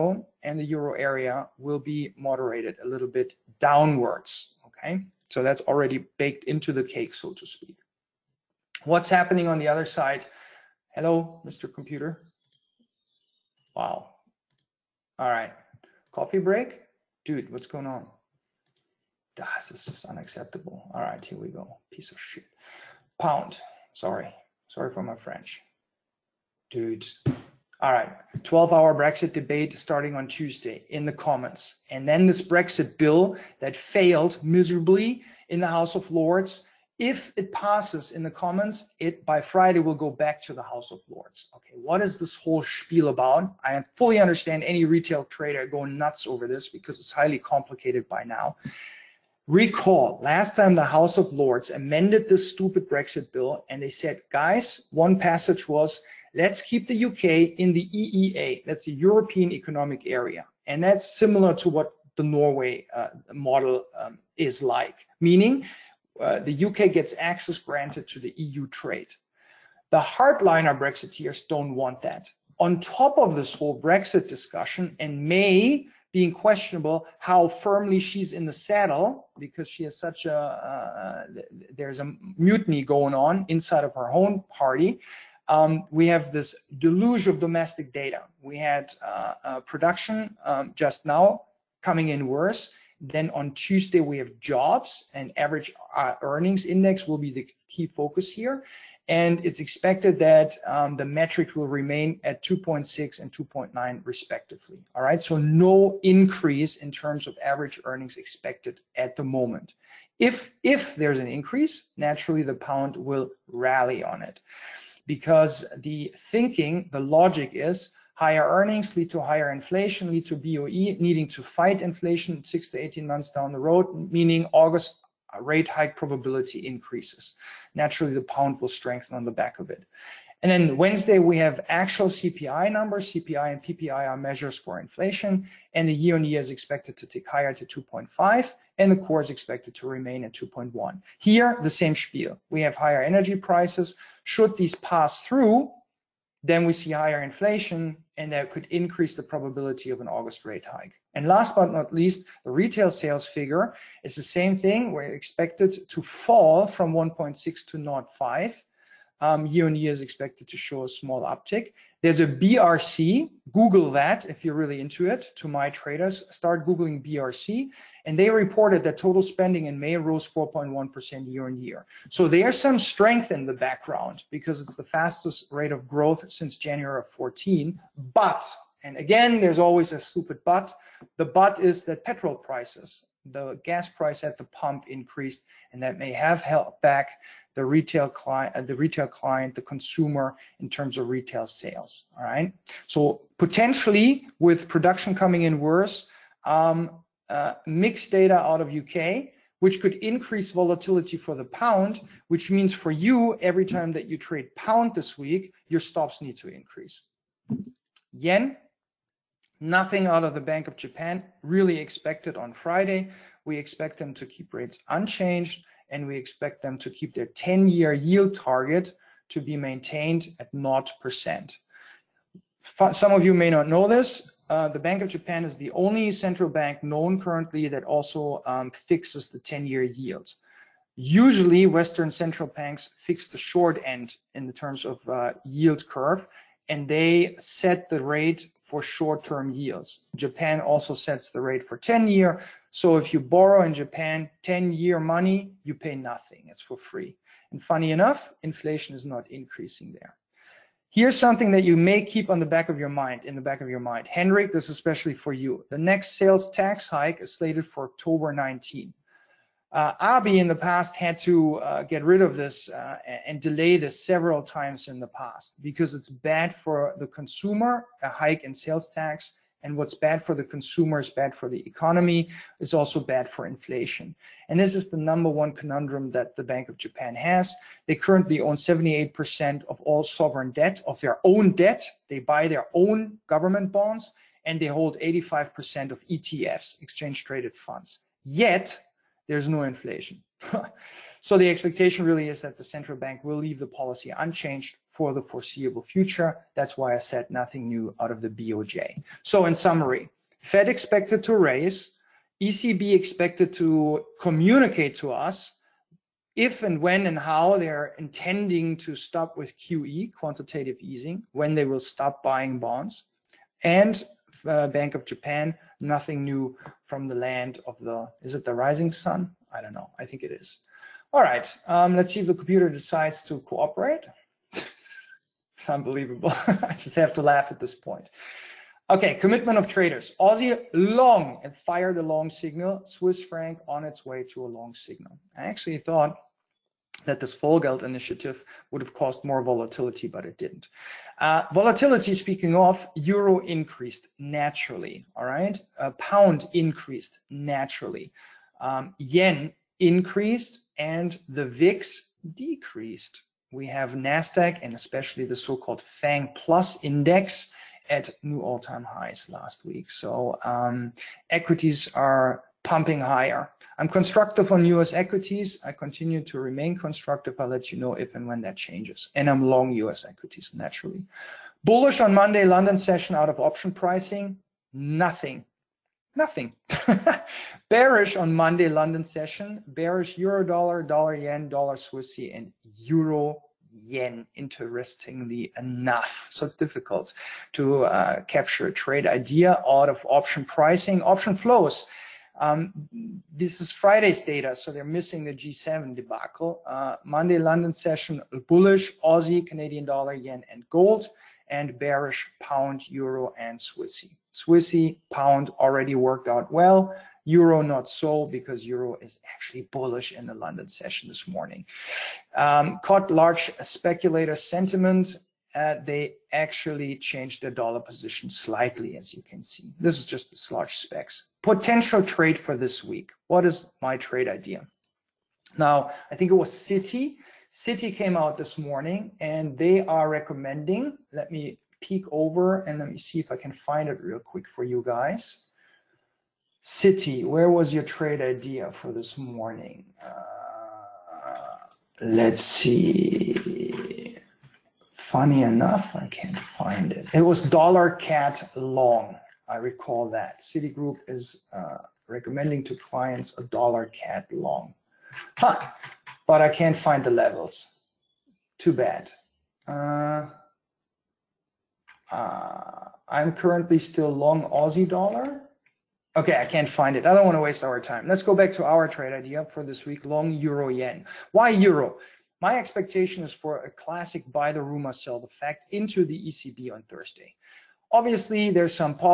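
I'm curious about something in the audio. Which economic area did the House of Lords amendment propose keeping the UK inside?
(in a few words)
EEA.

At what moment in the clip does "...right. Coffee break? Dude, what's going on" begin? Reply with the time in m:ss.
0:15.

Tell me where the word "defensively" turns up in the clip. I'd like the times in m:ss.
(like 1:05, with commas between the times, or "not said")
not said.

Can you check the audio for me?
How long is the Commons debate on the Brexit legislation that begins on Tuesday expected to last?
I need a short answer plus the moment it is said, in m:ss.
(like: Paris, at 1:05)
12 hours, at 0:28.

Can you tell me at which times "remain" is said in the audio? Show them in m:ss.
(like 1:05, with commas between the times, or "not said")
1:41, 2:19, 6:06.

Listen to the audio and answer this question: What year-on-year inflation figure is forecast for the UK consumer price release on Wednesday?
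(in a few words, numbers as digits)
2.5.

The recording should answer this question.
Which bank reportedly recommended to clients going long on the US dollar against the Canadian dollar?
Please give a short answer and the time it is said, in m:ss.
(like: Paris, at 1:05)
Citigroup, at 7:30.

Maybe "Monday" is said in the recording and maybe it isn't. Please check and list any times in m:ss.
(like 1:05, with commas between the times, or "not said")
6:12, 6:18, 6:37.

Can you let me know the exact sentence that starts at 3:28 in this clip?
Yen, Nothing out of the Bank of Japan really expected on Friday.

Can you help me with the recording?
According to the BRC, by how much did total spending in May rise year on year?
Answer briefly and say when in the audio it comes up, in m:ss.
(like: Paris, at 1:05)
4.1%, at 2:50.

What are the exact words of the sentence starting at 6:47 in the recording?
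Euro not so because euro is actually bullish in the London session this morning.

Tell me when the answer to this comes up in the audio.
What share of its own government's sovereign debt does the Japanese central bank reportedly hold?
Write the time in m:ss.
4:38.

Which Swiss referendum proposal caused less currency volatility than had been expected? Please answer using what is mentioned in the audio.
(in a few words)
Vollgeld initiative.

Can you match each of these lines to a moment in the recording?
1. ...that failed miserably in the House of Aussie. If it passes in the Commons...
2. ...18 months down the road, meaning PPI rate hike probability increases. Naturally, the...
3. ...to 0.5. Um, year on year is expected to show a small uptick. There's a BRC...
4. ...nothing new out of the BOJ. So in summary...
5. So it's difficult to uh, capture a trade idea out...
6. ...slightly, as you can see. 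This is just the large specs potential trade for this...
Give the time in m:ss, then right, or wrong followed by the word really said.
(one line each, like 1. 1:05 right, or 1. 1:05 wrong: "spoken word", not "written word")
1. 0:33 wrong: "Lords", not "Aussie"
2. 2:02 wrong: "August", not "PPI"
3. 2:37 right
4. 4:57 right
5. 6:26 right
6. 6:58 right.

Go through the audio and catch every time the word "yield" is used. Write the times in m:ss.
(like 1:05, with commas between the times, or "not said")
3:37, 3:49, 3:55, 3:59.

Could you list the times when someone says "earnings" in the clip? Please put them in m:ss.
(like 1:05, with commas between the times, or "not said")
1:36, 1:47, 1:58.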